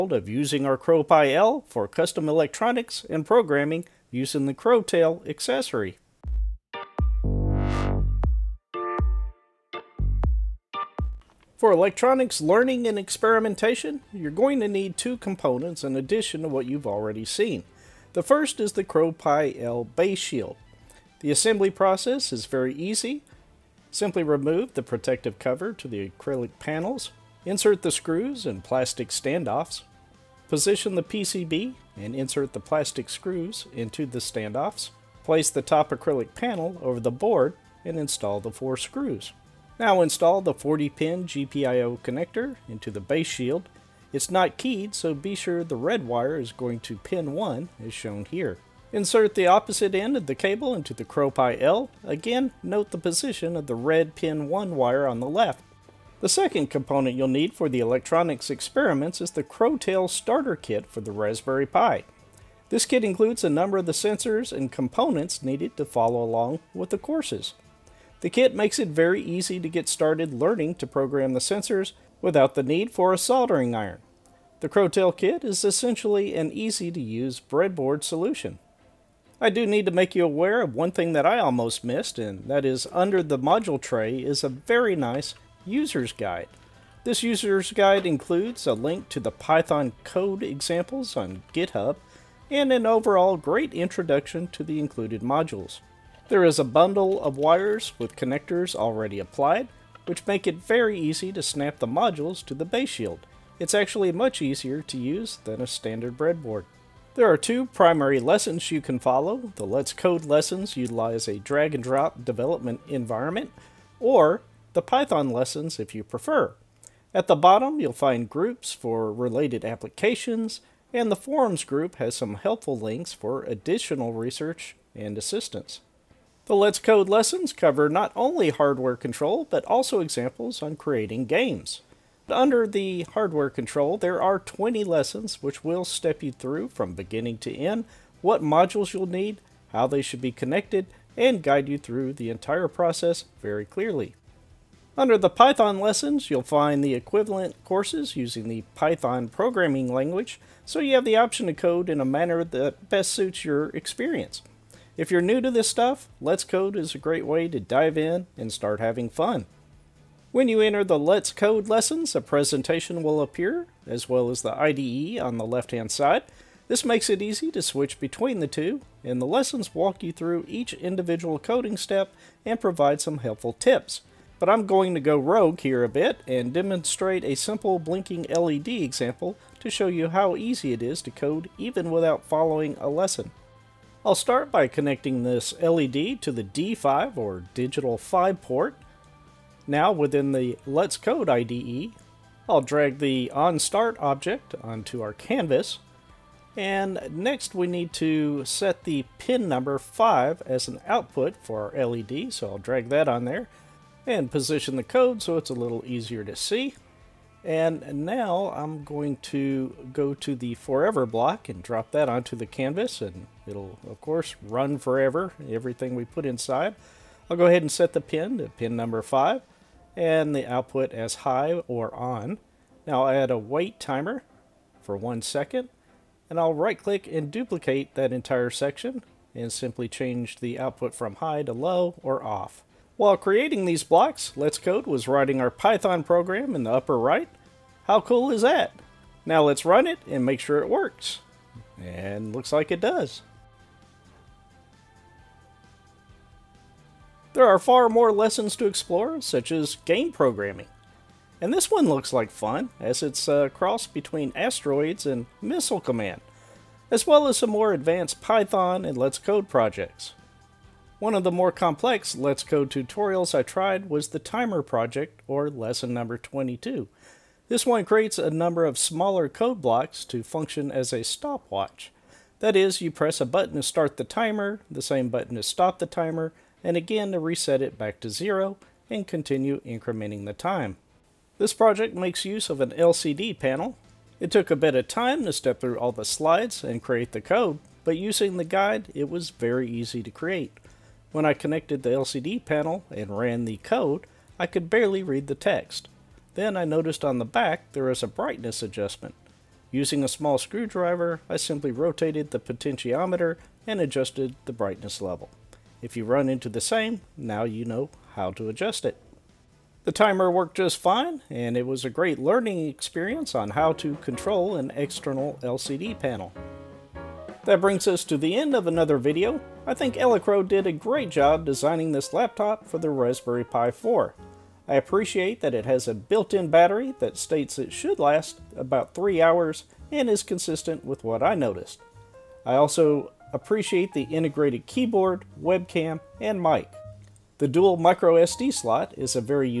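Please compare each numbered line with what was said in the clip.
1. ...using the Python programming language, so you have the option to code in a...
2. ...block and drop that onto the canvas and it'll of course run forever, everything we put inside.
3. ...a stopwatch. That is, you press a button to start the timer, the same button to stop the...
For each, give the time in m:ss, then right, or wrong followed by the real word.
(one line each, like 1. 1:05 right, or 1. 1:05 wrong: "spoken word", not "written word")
1. 2:28 right
2. 3:31 right
3. 4:30 right.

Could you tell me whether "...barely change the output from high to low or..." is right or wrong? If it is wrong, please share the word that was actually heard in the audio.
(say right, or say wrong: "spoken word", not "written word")
wrong: "simply", not "barely".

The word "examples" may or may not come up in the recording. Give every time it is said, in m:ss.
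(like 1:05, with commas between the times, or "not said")
1:30, 2:09, 2:58.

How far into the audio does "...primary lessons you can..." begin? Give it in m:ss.
1:47.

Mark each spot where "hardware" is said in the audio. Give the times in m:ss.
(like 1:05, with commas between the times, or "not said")
2:08, 2:13.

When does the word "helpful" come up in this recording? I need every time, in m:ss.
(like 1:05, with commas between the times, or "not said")
2:02, 2:53.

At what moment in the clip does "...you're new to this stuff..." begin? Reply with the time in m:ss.
2:35.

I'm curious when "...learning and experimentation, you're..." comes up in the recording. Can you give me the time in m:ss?
0:12.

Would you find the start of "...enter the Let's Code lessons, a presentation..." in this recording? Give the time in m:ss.
2:40.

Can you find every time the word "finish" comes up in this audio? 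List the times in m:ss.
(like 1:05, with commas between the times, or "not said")
not said.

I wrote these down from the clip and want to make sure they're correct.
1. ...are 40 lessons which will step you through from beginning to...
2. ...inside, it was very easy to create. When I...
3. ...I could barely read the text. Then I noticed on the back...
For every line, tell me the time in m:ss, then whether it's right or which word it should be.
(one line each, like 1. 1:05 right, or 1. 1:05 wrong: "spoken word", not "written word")
1. 2:14 wrong: "20", not "40"
2. 4:48 wrong: "guide", not "inside"
3. 4:54 right.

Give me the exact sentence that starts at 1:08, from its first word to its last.
The kit makes it very easy to get started learning to program the sensors without the need for a soldering iron.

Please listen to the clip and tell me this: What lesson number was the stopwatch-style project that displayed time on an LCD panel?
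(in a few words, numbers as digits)
22.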